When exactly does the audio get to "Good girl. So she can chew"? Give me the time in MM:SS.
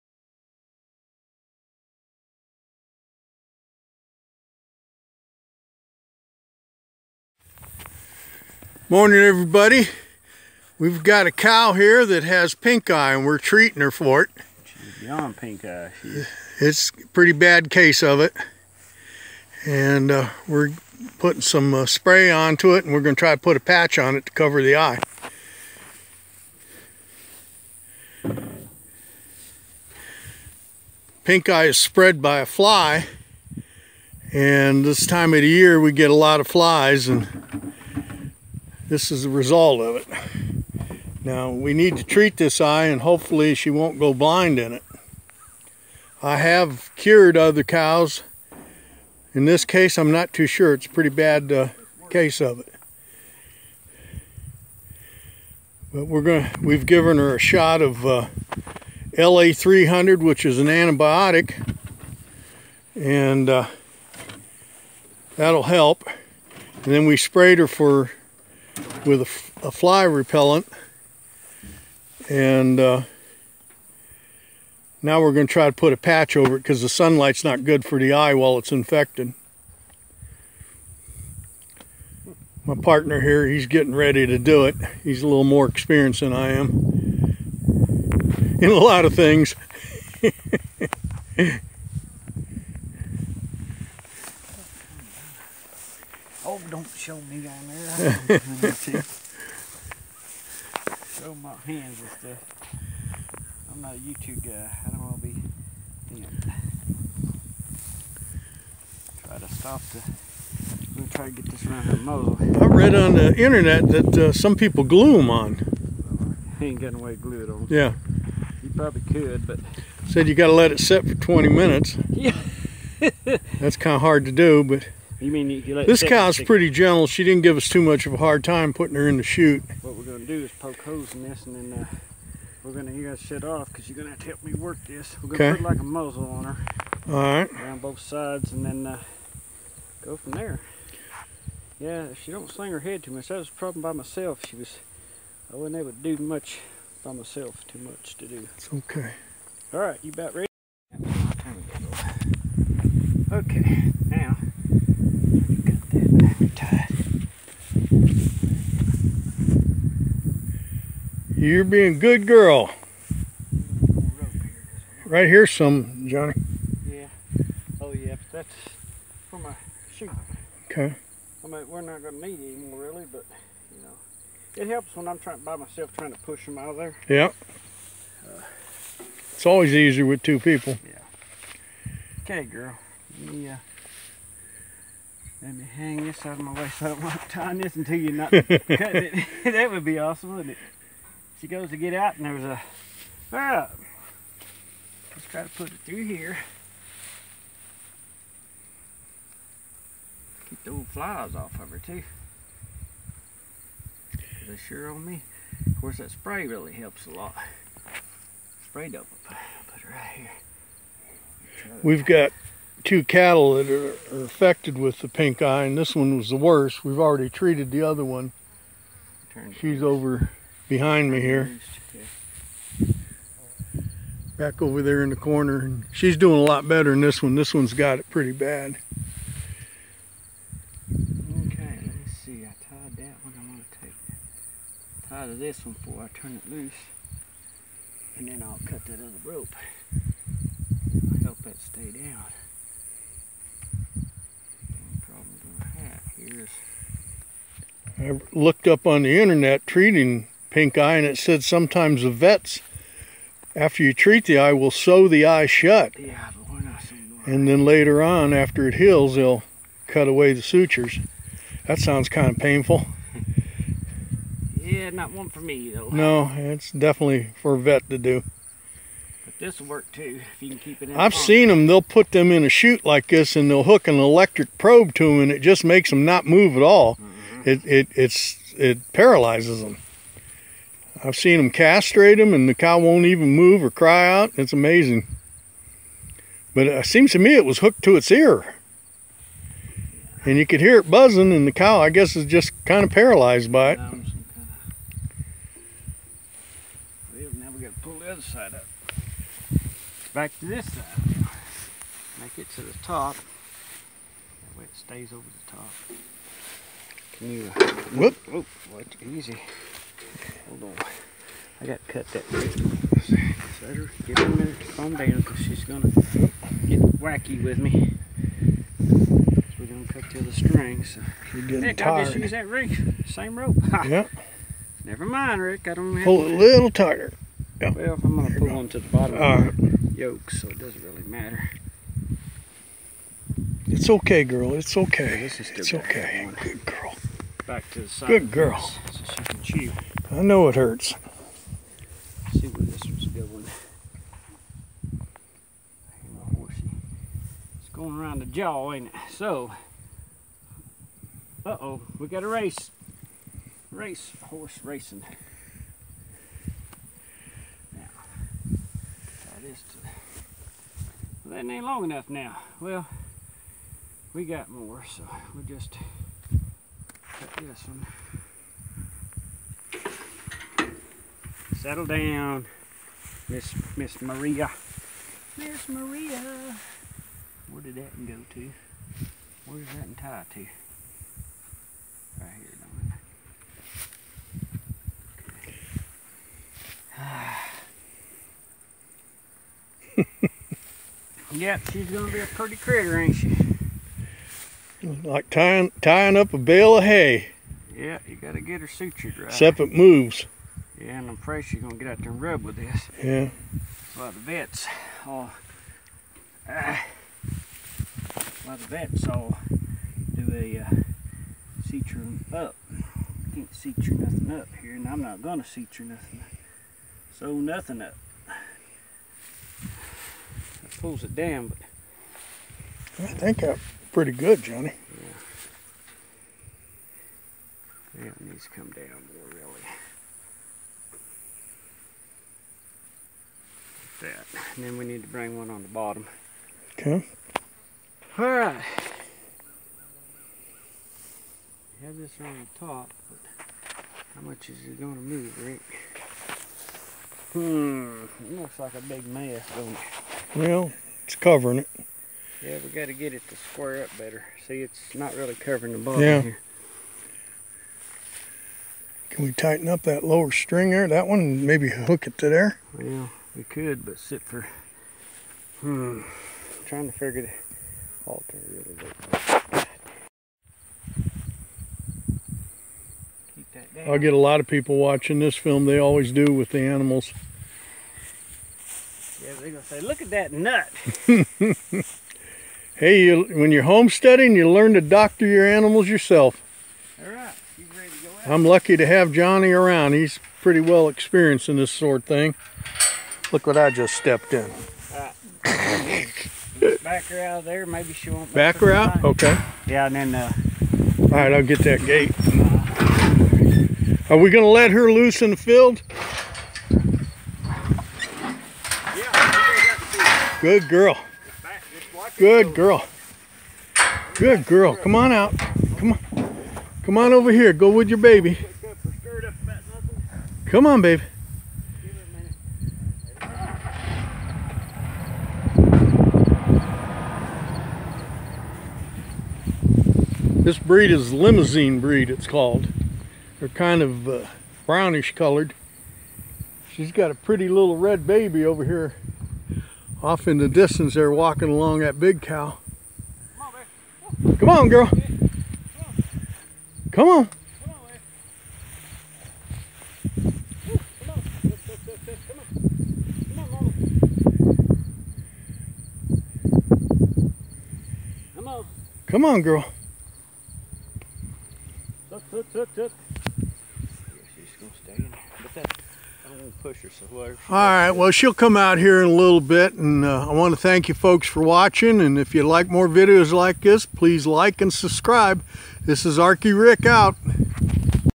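05:38.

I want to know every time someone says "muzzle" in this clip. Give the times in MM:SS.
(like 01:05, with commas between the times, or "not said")
01:51, 02:15.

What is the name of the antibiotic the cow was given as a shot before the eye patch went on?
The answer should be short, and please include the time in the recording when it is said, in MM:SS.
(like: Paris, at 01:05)
LA300, at 00:59.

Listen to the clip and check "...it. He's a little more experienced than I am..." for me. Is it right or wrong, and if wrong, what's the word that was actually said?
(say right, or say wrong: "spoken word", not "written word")
right.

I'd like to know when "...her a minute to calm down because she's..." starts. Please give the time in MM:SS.
05:14.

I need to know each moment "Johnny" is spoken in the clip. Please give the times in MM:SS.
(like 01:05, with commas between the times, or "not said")
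02:46, 07:04, 08:09.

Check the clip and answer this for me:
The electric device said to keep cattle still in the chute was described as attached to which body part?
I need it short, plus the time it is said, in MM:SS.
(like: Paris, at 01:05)
Ear, at 04:48.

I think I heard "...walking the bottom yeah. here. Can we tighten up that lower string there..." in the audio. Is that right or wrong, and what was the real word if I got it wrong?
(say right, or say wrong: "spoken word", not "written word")
wrong: "covering", not "walking".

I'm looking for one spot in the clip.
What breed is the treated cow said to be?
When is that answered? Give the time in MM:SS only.
08:51.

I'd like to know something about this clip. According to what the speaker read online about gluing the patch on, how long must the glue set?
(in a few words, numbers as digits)
20 minutes.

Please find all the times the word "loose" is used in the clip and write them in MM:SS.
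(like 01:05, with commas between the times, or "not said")
03:56, 08:24.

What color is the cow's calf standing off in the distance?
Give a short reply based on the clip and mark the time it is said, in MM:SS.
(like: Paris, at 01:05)
Red, at 08:57.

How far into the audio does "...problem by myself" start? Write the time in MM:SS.
02:23.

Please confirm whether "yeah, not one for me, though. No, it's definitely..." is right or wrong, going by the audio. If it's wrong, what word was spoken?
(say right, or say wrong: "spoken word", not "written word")
right.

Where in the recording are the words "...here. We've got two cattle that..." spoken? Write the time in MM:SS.
03:30.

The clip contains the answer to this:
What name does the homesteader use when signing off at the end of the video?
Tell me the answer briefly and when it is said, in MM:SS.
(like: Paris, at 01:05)
Arky Rick, at 09:36.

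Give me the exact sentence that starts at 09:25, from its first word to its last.
But that, I not push her so hard.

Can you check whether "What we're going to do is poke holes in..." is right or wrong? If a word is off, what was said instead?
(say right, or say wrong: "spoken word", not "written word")
right.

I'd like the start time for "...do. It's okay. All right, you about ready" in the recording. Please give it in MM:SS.
02:28.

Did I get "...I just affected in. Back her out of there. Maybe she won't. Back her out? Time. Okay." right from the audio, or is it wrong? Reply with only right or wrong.
wrong.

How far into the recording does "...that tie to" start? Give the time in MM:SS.
06:19.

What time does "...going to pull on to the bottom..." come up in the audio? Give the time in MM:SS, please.
05:28.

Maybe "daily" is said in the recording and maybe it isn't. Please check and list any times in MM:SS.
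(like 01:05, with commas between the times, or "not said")
not said.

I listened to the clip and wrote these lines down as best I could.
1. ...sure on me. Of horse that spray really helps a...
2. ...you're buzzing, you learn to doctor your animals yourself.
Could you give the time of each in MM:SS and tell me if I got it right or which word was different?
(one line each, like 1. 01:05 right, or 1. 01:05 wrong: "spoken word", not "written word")
1. 03:24 wrong: "course", not "horse"
2. 08:03 wrong: "homesteading", not "buzzing".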